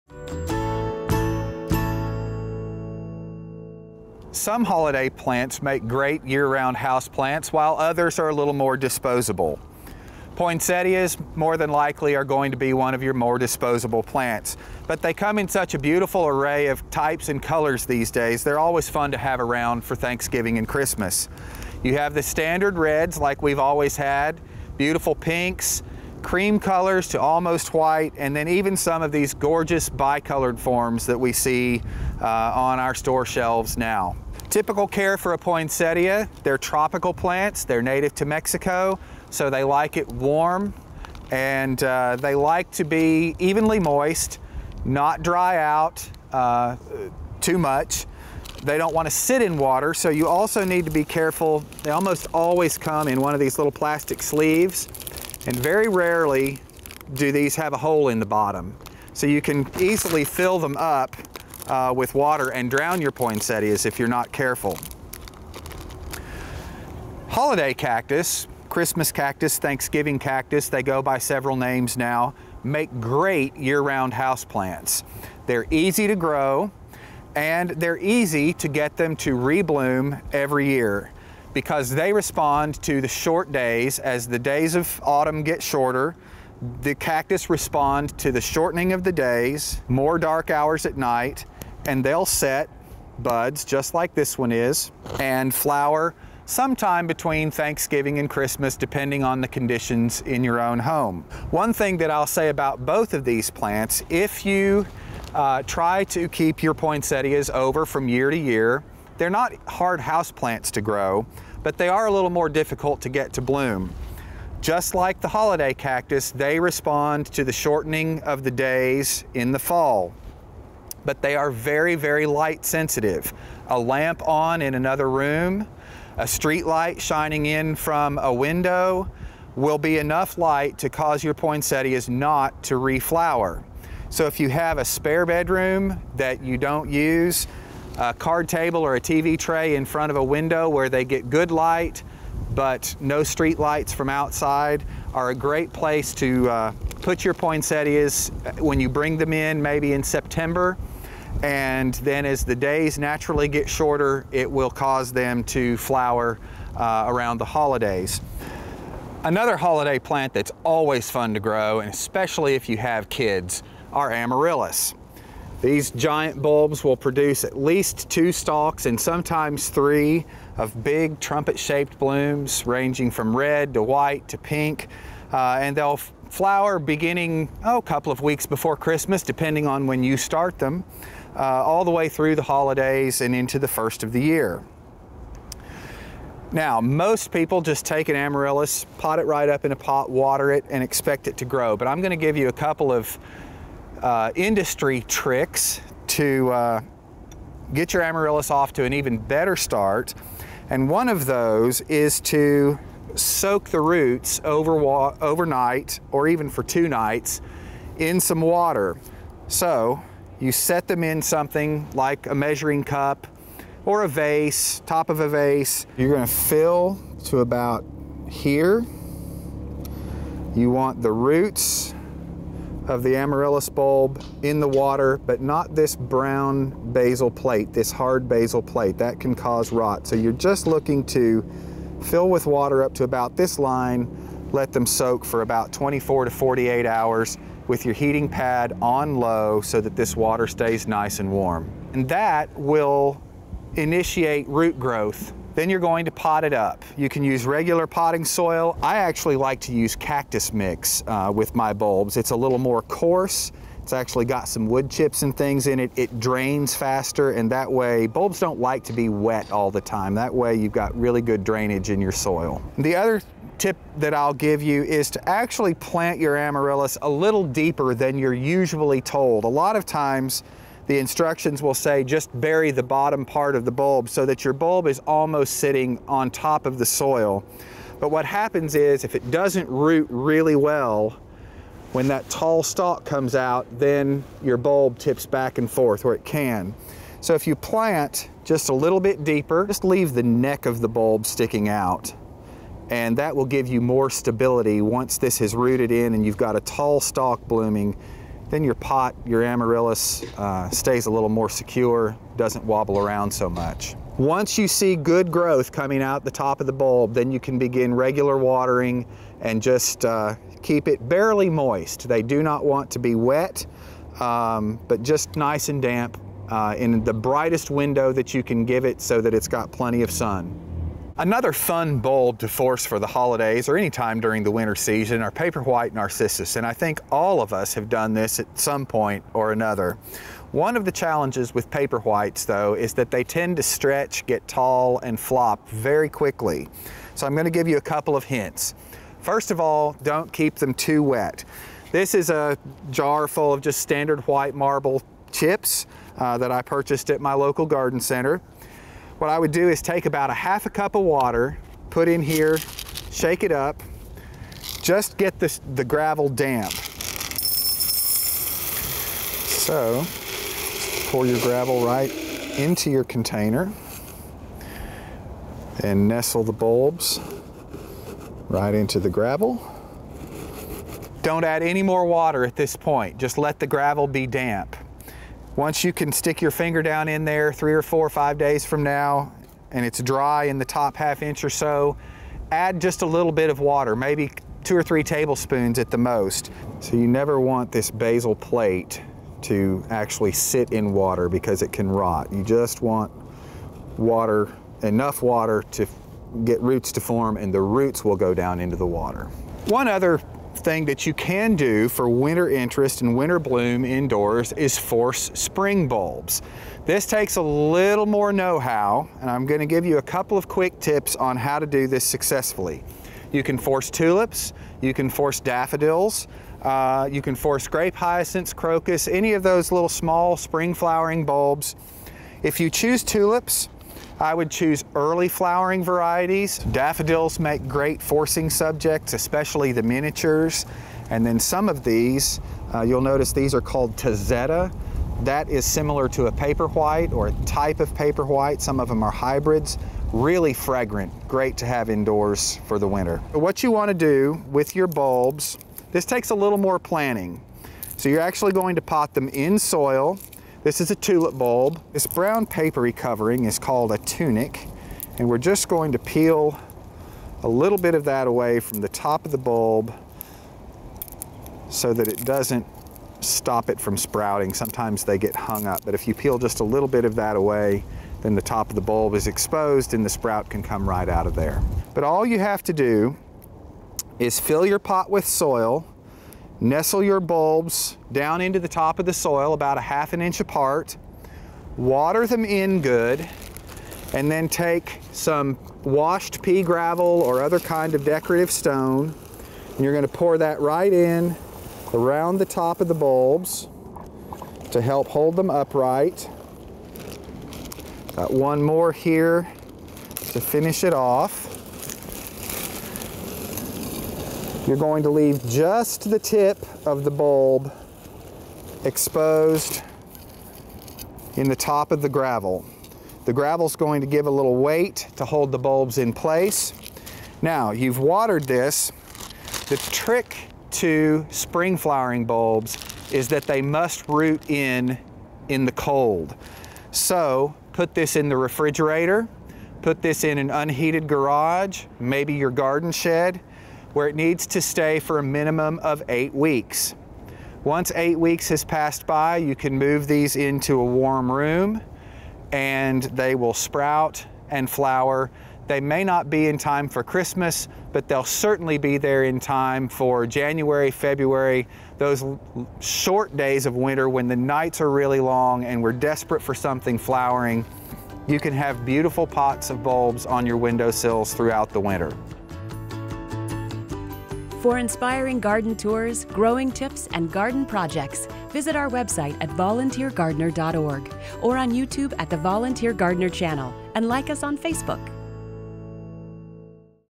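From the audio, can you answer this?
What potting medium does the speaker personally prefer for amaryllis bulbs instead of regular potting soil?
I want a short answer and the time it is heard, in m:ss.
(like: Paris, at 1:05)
cactus mix, at 4:09.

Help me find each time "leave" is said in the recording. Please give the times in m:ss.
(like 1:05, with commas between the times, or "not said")
4:49, 8:25.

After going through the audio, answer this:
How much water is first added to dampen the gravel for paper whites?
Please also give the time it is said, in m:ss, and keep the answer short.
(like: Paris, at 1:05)
half a cup, at 5:50.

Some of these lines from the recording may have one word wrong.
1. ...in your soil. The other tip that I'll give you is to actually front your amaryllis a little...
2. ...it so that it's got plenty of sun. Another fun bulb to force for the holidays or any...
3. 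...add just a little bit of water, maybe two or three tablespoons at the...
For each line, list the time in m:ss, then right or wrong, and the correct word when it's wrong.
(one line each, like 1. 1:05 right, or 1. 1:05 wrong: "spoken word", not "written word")
1. 4:21 wrong: "plant", not "front"
2. 5:18 right
3. 6:22 right.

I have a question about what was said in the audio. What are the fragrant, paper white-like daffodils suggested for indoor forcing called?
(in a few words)
Tazetta.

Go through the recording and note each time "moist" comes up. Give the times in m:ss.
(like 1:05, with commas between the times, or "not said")
0:43, 5:11.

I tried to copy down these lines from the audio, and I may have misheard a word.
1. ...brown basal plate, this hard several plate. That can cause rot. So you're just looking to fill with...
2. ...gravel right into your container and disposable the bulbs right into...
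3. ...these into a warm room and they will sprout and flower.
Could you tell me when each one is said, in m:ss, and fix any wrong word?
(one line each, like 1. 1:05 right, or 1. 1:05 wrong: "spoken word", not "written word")
1. 3:45 wrong: "basal", not "several"
2. 6:01 wrong: "nestle", not "disposable"
3. 9:00 right.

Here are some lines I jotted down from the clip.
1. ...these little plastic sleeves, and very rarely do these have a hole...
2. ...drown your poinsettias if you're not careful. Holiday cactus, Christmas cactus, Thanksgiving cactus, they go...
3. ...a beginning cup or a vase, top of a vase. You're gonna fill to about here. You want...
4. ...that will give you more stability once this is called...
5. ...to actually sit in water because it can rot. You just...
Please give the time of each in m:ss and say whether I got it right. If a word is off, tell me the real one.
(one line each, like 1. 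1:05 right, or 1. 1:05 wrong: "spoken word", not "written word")
1. 0:53 right
2. 1:02 right
3. 3:32 wrong: "measuring", not "beginning"
4. 4:53 wrong: "rooted", not "called"
5. 6:29 right.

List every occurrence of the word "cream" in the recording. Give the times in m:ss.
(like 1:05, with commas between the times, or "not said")
0:26.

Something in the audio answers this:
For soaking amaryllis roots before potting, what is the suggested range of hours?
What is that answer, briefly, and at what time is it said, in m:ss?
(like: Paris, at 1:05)
24 to 48 hours, at 3:55.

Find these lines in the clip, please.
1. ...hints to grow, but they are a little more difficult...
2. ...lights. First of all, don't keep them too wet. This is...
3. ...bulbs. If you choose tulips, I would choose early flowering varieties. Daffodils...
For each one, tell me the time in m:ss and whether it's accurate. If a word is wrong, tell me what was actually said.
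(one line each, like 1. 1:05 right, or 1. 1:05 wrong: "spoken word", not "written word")
1. 1:50 wrong: "plants", not "hints"
2. 5:38 wrong: "hints", not "lights"
3. 7:01 right.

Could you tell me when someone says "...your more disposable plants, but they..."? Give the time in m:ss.
0:13.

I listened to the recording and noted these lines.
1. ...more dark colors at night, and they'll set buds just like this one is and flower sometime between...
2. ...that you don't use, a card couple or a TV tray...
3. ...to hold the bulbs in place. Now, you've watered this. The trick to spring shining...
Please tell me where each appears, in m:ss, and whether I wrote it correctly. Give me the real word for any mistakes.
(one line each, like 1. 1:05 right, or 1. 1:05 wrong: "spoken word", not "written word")
1. 1:29 wrong: "hours", not "colors"
2. 2:16 wrong: "table", not "couple"
3. 8:35 wrong: "flowering", not "shining".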